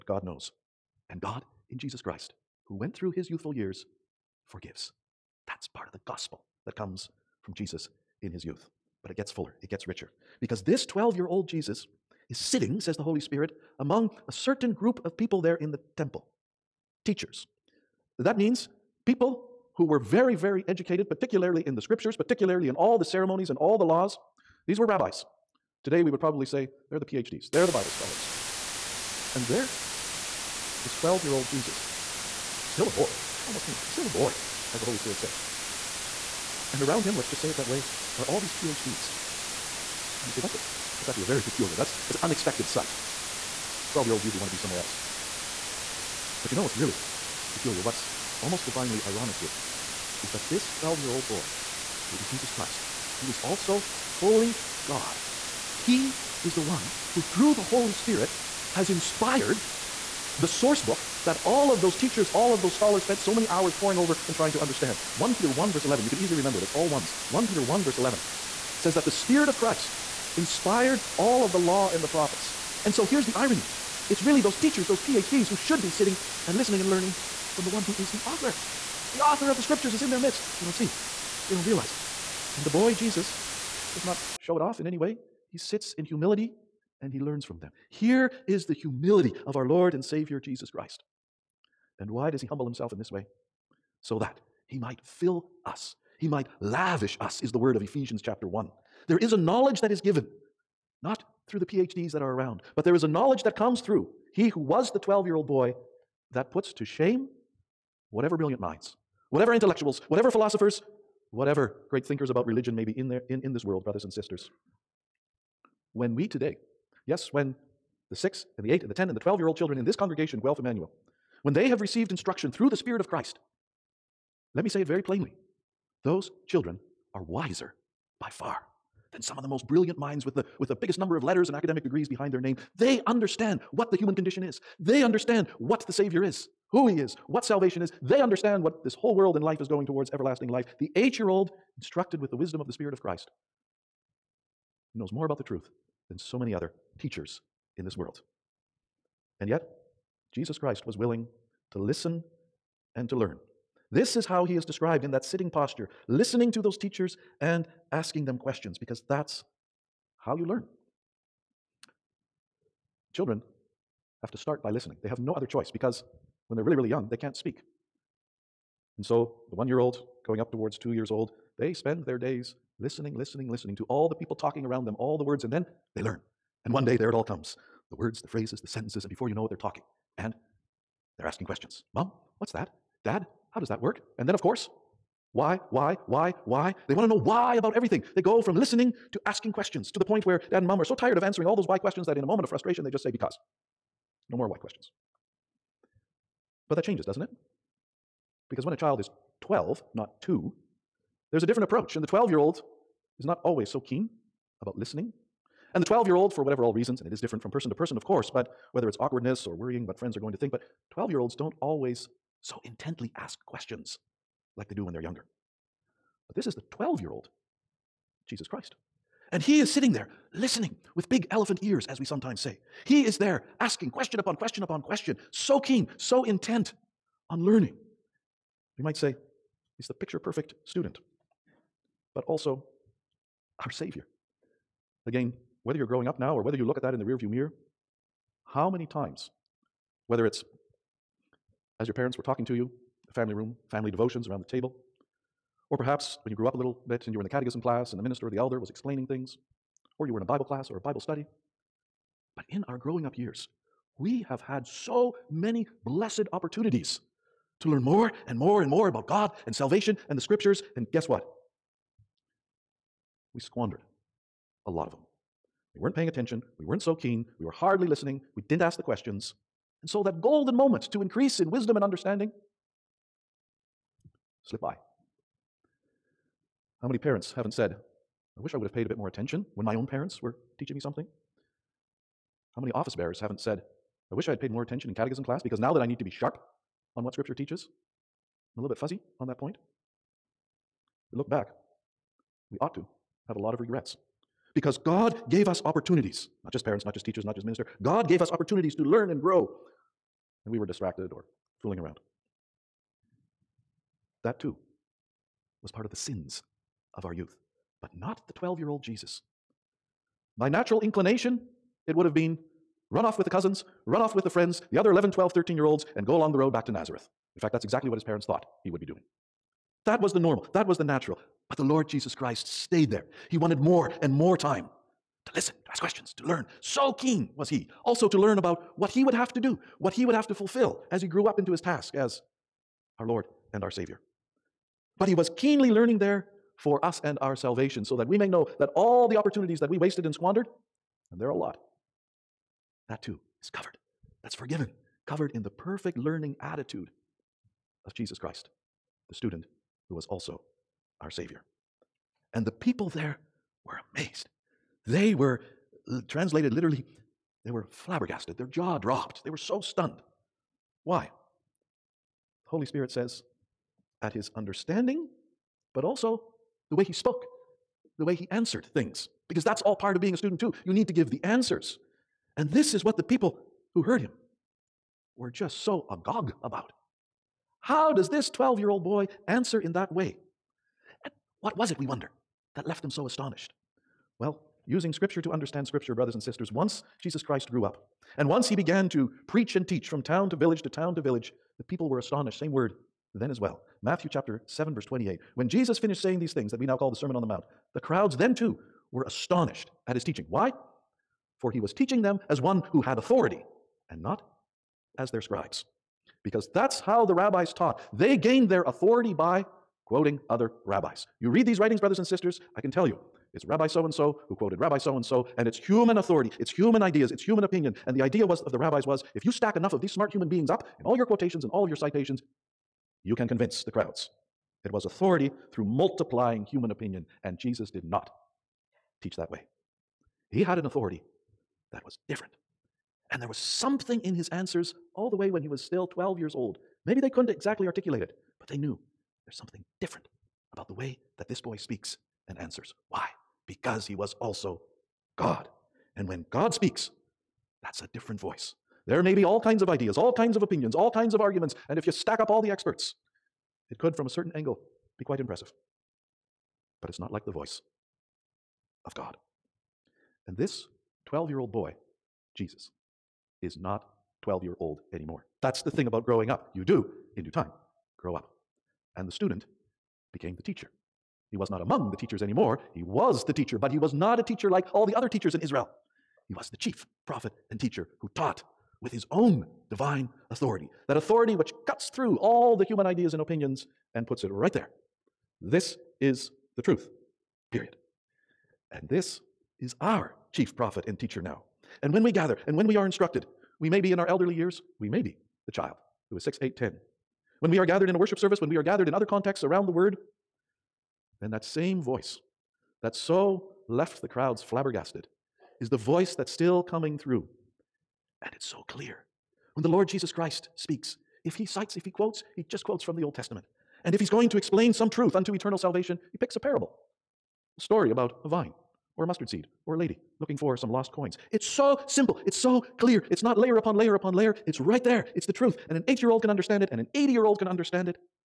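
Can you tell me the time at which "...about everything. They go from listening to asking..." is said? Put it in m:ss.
3:07.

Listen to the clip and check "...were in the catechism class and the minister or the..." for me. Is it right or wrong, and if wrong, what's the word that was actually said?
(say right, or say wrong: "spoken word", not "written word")
right.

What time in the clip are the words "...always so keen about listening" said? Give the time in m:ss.
3:23.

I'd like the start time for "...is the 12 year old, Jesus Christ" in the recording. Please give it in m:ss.
3:36.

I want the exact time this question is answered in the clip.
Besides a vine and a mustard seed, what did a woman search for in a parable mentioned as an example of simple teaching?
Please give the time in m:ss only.
8:40.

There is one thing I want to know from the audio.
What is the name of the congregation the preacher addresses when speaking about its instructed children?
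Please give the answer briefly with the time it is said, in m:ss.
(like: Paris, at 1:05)
Guelph Emmanuel, at 2:00.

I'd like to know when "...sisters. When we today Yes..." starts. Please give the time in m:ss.
1:54.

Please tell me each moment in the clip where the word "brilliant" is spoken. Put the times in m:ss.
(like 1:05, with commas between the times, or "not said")
1:48, 2:09.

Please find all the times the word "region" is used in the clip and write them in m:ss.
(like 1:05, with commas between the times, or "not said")
not said.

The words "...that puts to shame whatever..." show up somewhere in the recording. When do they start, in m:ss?
1:46.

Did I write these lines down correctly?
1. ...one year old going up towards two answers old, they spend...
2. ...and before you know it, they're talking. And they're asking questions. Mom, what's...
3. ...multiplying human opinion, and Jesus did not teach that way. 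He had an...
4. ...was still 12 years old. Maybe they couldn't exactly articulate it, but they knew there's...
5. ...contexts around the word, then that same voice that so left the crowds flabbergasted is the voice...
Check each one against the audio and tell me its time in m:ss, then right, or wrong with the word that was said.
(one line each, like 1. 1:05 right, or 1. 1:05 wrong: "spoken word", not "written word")
1. 2:49 wrong: "years", not "answers"
2. 2:59 right
3. 7:05 right
4. 7:15 right
5. 8:19 right.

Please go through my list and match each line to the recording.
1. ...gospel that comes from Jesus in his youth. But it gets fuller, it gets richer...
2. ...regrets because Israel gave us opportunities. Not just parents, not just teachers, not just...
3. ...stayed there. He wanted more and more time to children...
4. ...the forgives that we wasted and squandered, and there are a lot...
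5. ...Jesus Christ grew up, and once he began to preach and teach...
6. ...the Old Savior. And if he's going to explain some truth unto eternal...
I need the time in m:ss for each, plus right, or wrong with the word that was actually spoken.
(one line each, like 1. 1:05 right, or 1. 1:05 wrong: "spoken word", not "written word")
1. 0:06 right
2. 4:53 wrong: "God", not "Israel"
3. 5:22 wrong: "listen", not "children"
4. 5:39 wrong: "opportunities", not "forgives"
5. 6:27 right
6. 8:32 wrong: "Testament", not "Savior".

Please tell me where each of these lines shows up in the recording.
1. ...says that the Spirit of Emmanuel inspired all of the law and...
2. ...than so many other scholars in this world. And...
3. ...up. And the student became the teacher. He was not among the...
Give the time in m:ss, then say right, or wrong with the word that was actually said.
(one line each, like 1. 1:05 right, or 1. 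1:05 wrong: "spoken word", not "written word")
1. 1:08 wrong: "Christ", not "Emmanuel"
2. 2:26 wrong: "teachers", not "scholars"
3. 7:48 right.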